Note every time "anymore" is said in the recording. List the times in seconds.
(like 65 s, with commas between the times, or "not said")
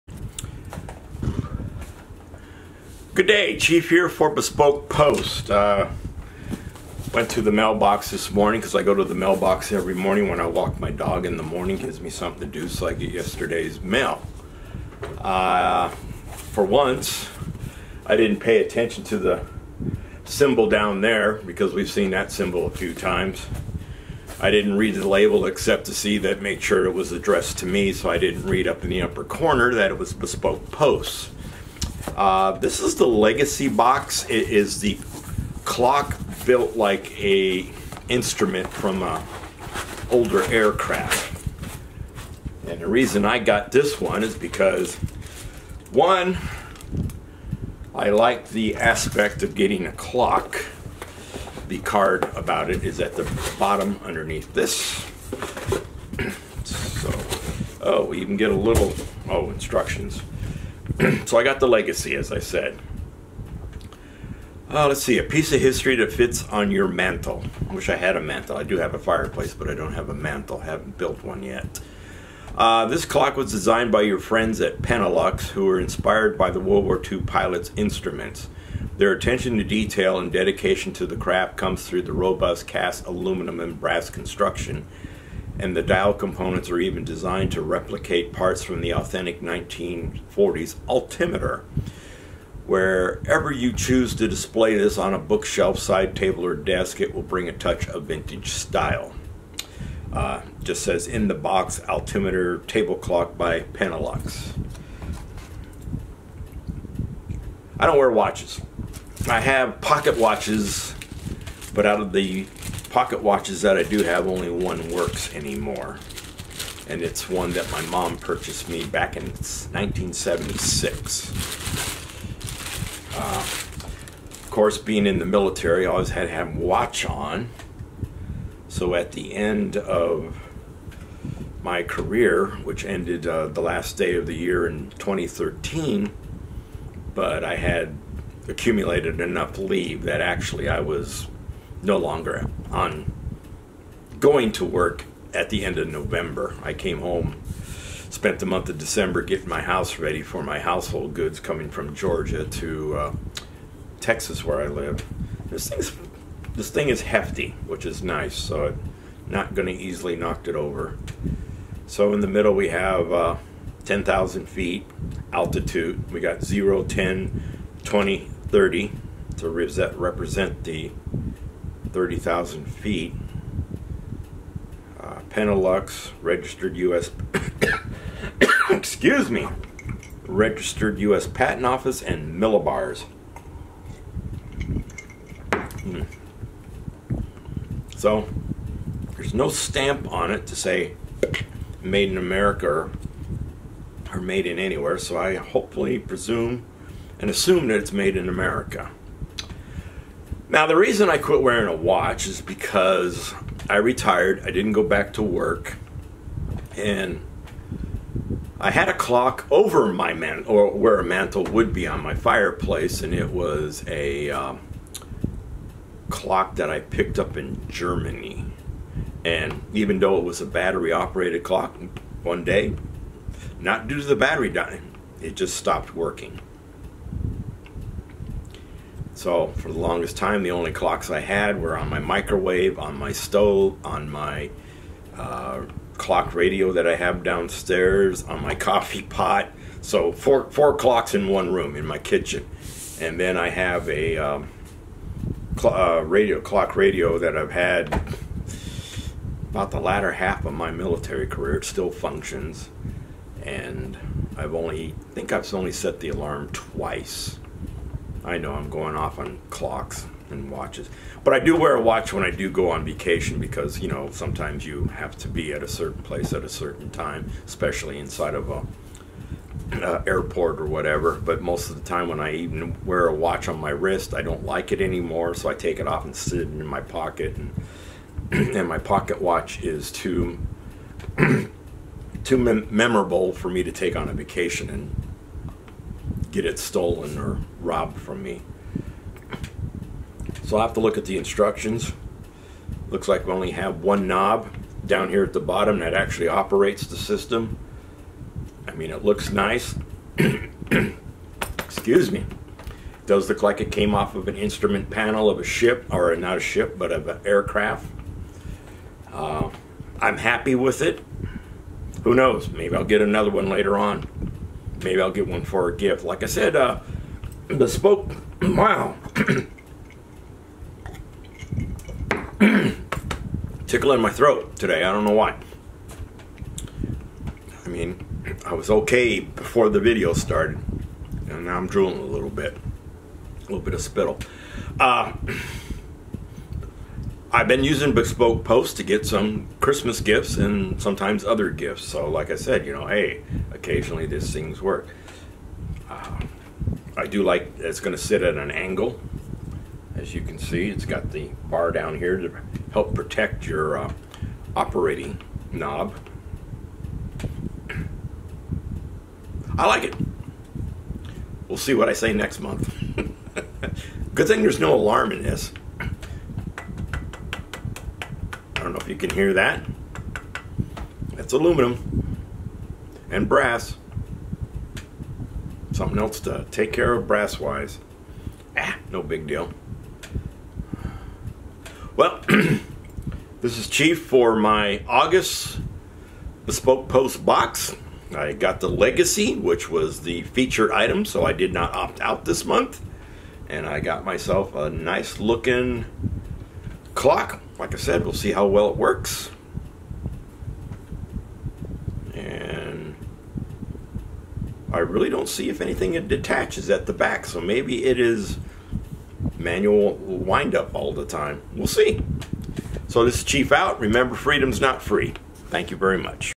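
115 s, 274 s.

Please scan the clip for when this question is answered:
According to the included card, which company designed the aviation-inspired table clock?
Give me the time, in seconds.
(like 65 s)
74 s.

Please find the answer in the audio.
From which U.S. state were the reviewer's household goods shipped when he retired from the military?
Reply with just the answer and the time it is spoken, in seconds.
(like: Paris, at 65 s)
Georgia, at 151 s.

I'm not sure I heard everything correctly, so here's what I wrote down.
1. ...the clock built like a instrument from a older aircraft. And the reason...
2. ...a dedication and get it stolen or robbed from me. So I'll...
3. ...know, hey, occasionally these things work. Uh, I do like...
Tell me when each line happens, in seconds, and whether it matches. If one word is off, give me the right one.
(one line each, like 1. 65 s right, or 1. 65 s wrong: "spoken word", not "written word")
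1. 34 s right
2. 284 s wrong: "vacation", not "dedication"
3. 342 s right.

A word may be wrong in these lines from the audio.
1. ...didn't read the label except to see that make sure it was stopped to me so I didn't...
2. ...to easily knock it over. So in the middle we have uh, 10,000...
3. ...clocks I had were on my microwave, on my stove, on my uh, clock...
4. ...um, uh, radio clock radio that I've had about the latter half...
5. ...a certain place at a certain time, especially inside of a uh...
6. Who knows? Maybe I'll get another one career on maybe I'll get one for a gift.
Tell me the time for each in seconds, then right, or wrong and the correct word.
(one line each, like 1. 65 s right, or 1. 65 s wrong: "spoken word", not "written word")
1. 24 s wrong: "addressed", not "stopped"
2. 159 s right
3. 230 s right
4. 244 s right
5. 265 s right
6. 312 s wrong: "later", not "career".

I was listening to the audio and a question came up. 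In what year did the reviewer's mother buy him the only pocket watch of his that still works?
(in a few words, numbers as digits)
1976.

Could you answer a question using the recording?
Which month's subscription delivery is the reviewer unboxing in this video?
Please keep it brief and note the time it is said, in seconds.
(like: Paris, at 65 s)
August, at 384 s.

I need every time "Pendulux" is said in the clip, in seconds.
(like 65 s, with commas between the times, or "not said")
103 s, 175 s.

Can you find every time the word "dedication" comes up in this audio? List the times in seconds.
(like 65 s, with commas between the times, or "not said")
80 s.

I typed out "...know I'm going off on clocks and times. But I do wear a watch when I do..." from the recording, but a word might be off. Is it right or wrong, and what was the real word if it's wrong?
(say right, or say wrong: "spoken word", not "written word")
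wrong: "watches", not "times".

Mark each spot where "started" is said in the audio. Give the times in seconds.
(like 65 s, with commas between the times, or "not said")
330 s.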